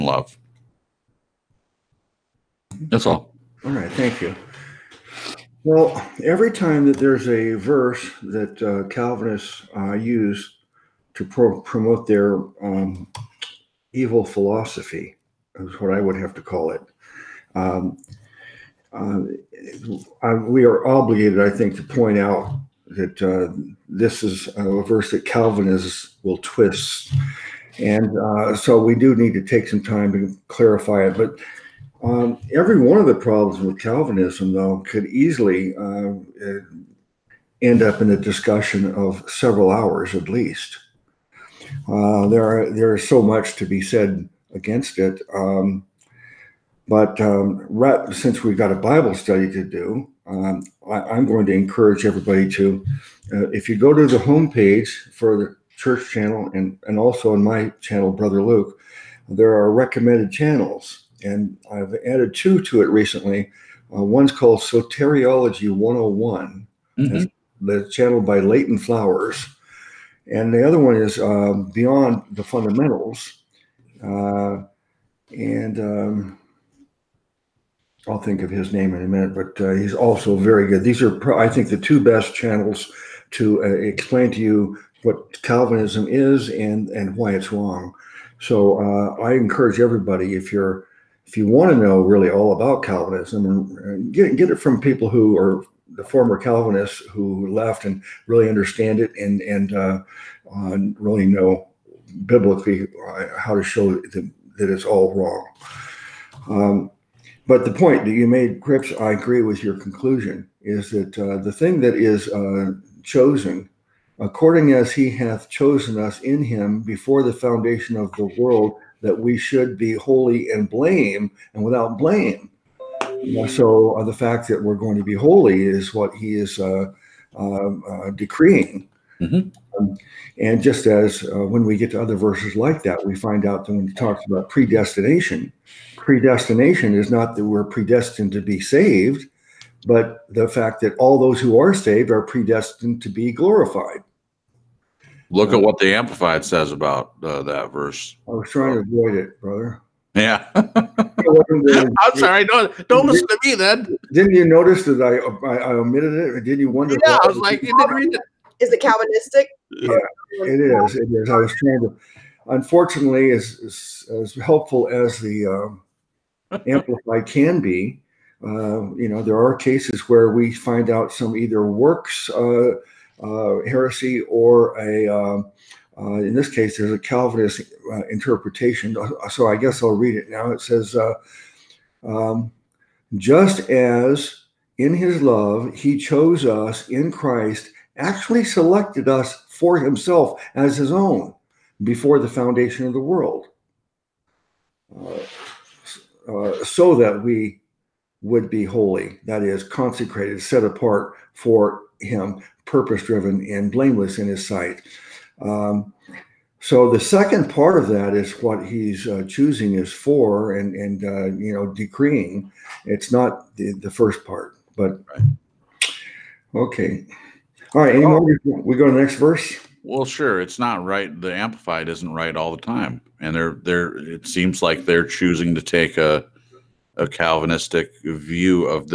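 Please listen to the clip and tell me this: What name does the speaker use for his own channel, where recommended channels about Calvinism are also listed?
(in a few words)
Brother Luke.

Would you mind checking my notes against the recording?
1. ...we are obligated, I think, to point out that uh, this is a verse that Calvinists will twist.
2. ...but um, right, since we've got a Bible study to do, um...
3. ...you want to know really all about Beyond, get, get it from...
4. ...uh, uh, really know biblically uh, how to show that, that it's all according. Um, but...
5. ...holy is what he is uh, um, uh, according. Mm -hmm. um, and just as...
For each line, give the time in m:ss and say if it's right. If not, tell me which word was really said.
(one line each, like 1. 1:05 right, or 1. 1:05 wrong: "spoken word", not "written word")
1. 0:20 right
2. 0:46 right
3. 1:31 wrong: "Calvinism", not "Beyond"
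4. 1:39 wrong: "wrong", not "according"
5. 2:05 wrong: "decreeing", not "according".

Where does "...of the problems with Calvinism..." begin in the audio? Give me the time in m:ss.
0:32.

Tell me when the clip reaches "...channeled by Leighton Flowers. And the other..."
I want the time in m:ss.
1:07.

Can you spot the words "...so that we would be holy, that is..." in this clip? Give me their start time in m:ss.
3:16.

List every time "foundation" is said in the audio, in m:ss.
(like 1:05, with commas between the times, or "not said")
1:57, 3:12.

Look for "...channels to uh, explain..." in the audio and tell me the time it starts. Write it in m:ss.
1:22.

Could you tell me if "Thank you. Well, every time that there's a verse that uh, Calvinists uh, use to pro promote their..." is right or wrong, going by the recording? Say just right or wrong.
right.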